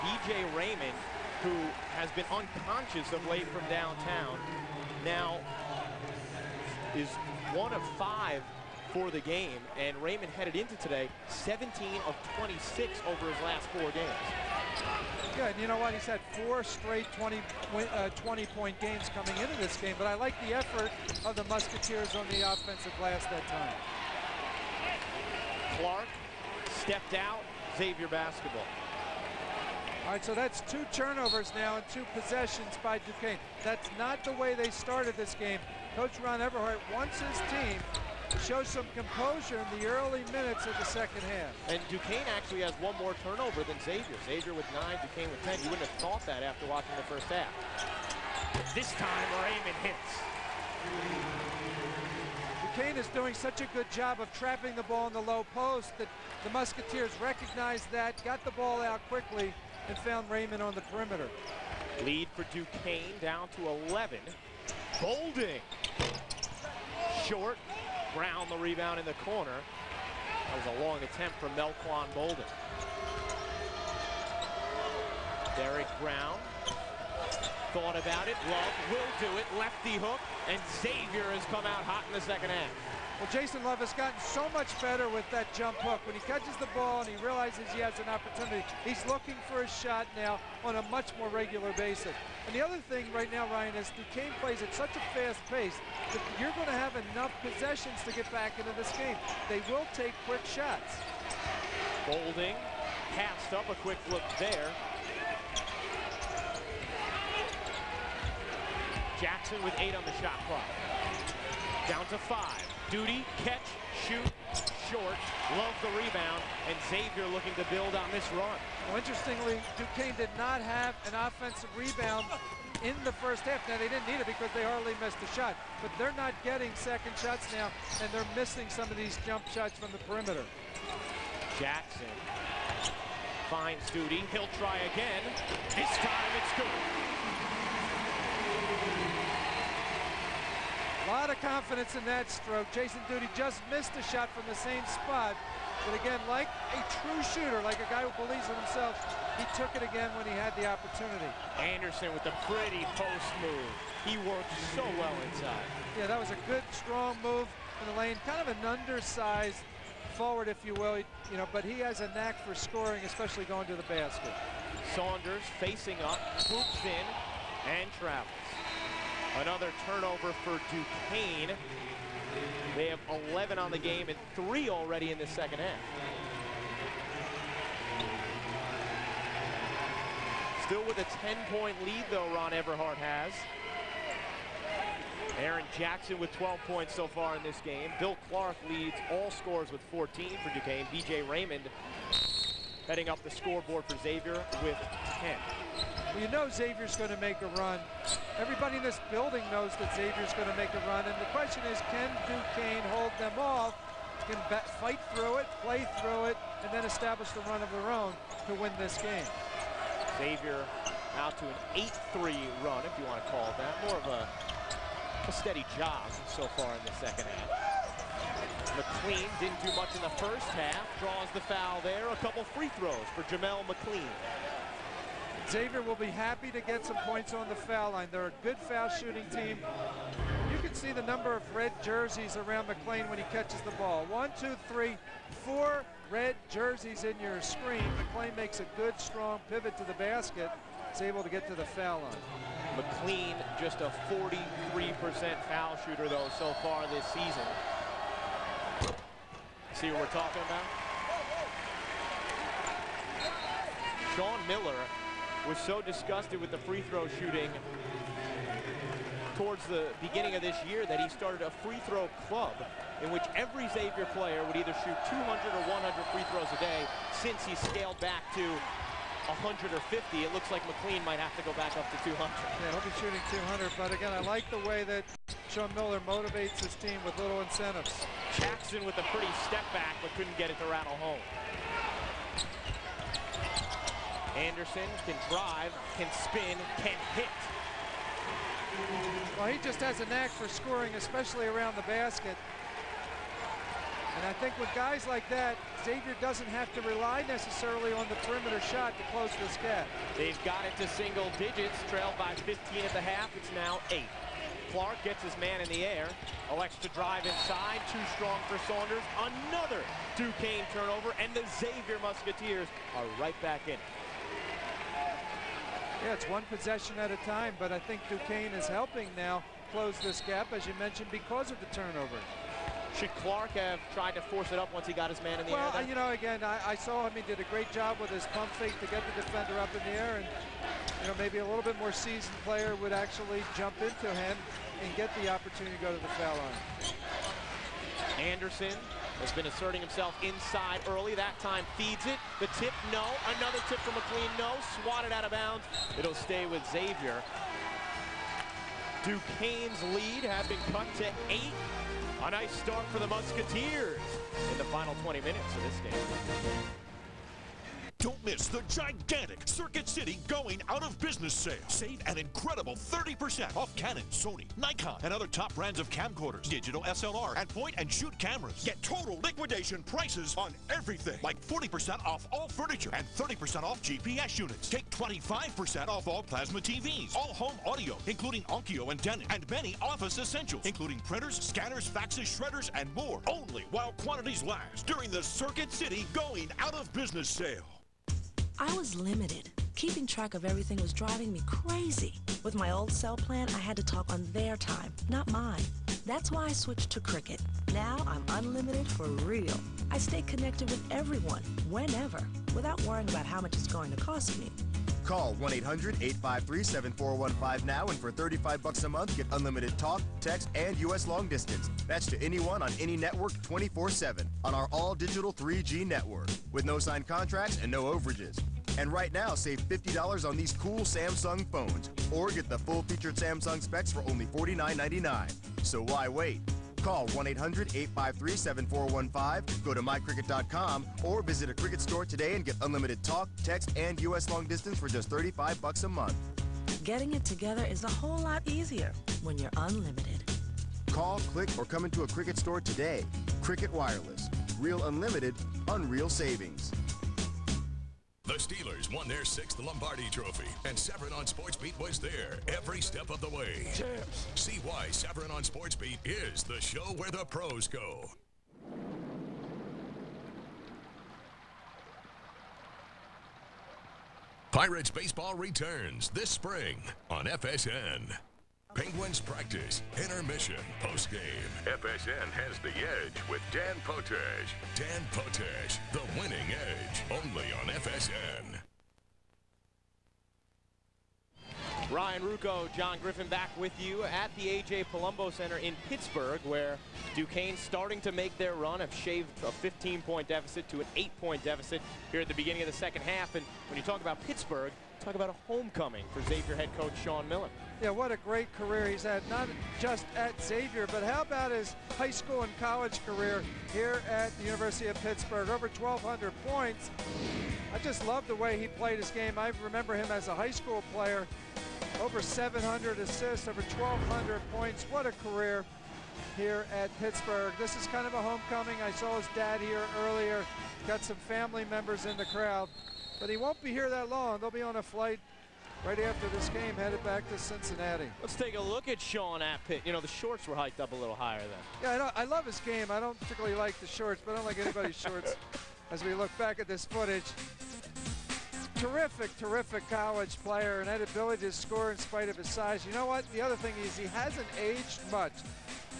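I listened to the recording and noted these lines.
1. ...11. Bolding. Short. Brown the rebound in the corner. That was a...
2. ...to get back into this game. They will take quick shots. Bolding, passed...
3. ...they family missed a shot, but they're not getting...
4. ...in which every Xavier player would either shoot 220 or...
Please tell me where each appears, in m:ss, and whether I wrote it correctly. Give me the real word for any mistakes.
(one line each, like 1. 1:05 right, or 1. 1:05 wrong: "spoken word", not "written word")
1. 1:03 right
2. 1:38 right
3. 2:04 wrong: "hardly", not "family"
4. 4:23 wrong: "200", not "220".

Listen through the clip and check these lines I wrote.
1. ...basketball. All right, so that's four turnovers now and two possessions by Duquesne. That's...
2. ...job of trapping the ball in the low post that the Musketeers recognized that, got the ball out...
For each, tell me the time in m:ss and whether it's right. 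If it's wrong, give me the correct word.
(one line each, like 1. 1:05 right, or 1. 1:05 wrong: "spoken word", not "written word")
1. 0:28 wrong: "two", not "four"
2. 0:53 right.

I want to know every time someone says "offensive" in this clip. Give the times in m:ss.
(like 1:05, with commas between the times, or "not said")
0:22, 2:01.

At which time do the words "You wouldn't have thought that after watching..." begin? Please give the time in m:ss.
0:45.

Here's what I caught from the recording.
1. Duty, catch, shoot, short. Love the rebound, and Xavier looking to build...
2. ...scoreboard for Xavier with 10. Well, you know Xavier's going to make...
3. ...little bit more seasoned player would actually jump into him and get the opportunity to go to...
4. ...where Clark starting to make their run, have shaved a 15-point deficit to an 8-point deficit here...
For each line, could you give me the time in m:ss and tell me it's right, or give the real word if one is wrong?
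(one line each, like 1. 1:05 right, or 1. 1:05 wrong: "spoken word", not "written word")
1. 1:52 right
2. 3:13 right
3. 5:31 right
4. 8:06 wrong: "Duquesne", not "Clark".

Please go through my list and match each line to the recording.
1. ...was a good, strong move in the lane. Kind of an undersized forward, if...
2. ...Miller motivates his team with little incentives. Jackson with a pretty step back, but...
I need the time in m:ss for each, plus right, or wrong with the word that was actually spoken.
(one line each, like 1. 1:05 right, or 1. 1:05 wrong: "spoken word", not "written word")
1. 2:36 right
2. 4:35 right.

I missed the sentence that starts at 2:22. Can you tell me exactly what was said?
Jason Duty just missed a shot from the same spot.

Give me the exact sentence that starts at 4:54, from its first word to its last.
And I think with guys like that, Xavier doesn't have to rely necessarily on the perimeter shot to close this gap.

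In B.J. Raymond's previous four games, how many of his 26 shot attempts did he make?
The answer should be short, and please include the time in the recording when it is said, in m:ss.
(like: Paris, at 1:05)
17, at 0:11.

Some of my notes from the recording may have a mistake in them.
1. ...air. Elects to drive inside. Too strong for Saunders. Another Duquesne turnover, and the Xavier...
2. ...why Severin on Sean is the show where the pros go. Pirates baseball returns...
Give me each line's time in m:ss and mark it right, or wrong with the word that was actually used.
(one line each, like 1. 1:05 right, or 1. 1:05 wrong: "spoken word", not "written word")
1. 5:05 right
2. 7:34 wrong: "SportsBeat", not "Sean".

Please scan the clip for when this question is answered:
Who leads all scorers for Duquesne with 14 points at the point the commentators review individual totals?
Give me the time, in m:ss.
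3:07.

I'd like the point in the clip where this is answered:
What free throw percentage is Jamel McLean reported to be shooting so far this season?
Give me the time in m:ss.
4:04.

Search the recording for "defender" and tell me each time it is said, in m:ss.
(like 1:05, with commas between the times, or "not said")
5:29.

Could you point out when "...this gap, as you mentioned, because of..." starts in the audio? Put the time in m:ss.
5:19.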